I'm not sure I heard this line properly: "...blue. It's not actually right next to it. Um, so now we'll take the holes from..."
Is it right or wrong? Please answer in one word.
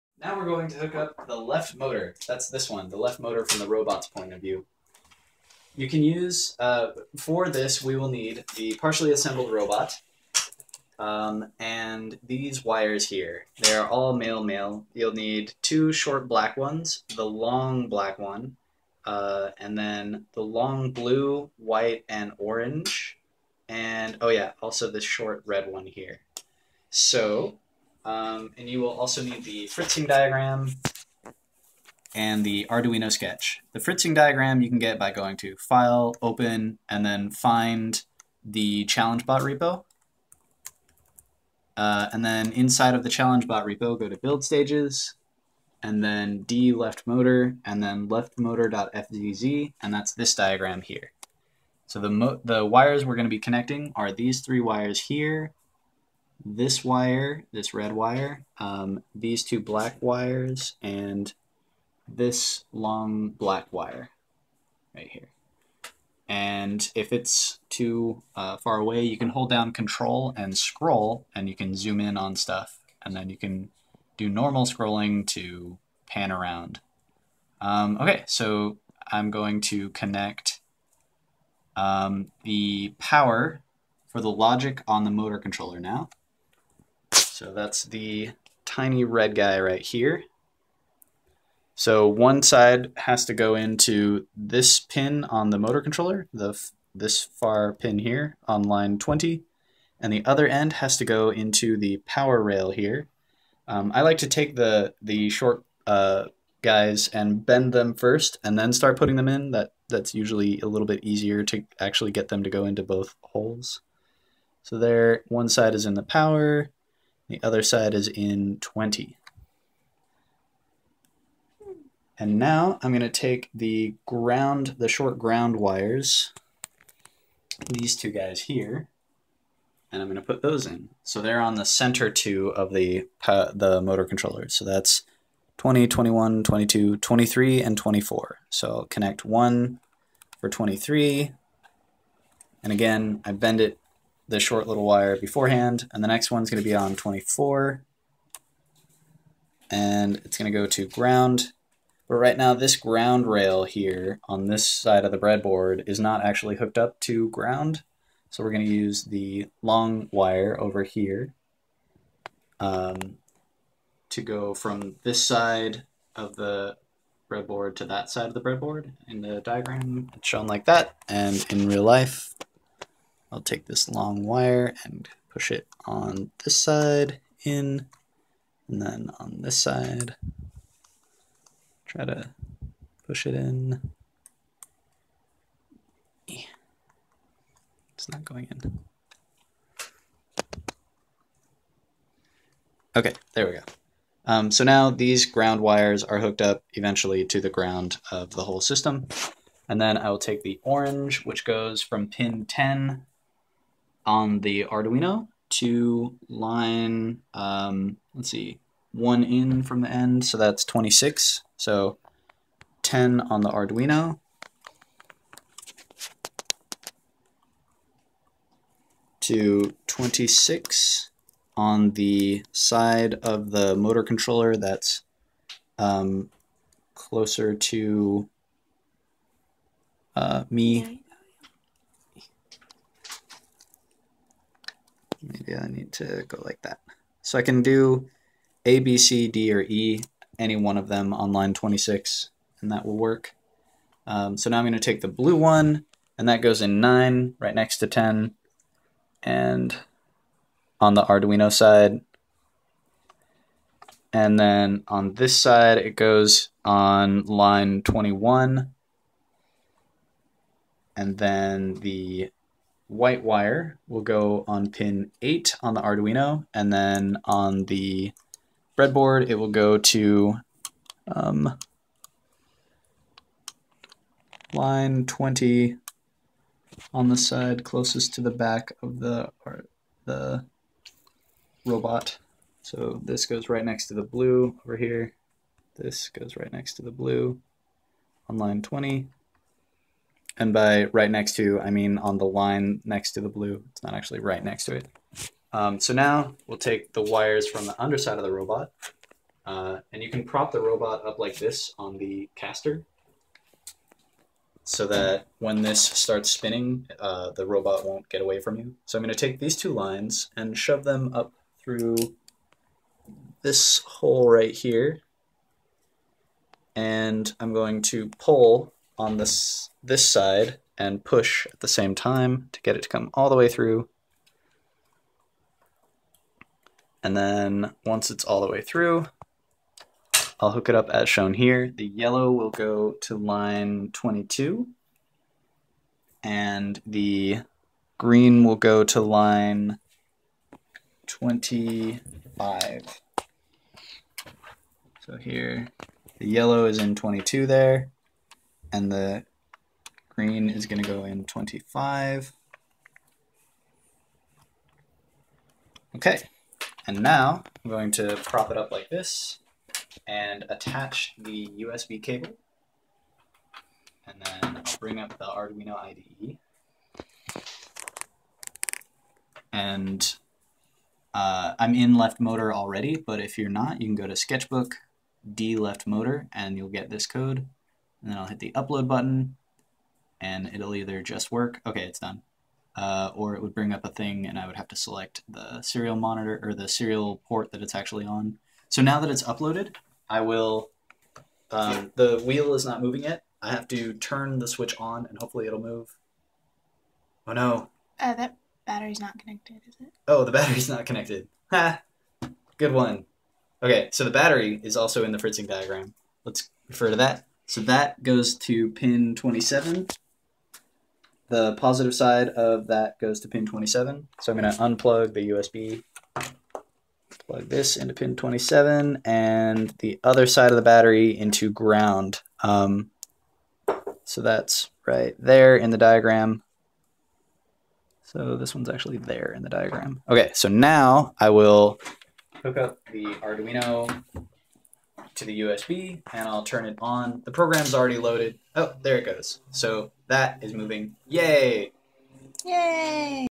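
wrong.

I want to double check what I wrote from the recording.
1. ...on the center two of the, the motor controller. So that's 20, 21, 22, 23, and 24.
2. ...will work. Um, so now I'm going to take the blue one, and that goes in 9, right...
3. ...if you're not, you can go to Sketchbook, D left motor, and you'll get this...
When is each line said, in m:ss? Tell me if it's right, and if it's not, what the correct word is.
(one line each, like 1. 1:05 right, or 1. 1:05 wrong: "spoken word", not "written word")
1. 2:11 right
2. 4:02 right
3. 6:13 right.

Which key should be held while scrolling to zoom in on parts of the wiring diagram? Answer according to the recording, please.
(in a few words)
Control.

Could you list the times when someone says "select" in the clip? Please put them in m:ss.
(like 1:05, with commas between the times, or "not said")
6:24.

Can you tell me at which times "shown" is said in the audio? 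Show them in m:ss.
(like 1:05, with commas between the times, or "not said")
2:50, 5:31.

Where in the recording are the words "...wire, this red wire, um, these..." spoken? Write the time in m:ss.
0:56.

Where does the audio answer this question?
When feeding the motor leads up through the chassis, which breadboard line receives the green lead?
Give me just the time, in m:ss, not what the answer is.
5:39.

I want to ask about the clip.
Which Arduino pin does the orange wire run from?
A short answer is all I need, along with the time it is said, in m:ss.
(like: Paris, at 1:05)
10, at 3:22.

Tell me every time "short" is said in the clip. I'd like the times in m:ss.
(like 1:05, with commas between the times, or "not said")
0:15, 0:25, 1:45, 2:04, 2:24.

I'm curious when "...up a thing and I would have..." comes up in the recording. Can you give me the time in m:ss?
6:23.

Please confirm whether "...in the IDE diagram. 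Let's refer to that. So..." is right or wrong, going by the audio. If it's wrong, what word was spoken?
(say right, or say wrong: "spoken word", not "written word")
wrong: "Fritzing", not "IDE".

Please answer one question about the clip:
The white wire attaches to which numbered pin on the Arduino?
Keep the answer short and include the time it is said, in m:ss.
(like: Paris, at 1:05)
8, at 4:24.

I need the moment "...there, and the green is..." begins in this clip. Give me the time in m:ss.
5:47.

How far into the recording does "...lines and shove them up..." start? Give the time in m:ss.
5:09.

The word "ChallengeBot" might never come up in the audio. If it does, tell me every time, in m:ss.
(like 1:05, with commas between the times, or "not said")
0:38, 0:43.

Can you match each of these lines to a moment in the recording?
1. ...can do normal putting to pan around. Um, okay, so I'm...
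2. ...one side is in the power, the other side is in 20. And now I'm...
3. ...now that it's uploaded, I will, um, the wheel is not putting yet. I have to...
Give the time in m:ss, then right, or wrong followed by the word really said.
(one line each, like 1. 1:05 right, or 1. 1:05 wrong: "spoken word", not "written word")
1. 1:13 wrong: "scrolling", not "putting"
2. 1:55 right
3. 6:28 wrong: "moving", not "putting".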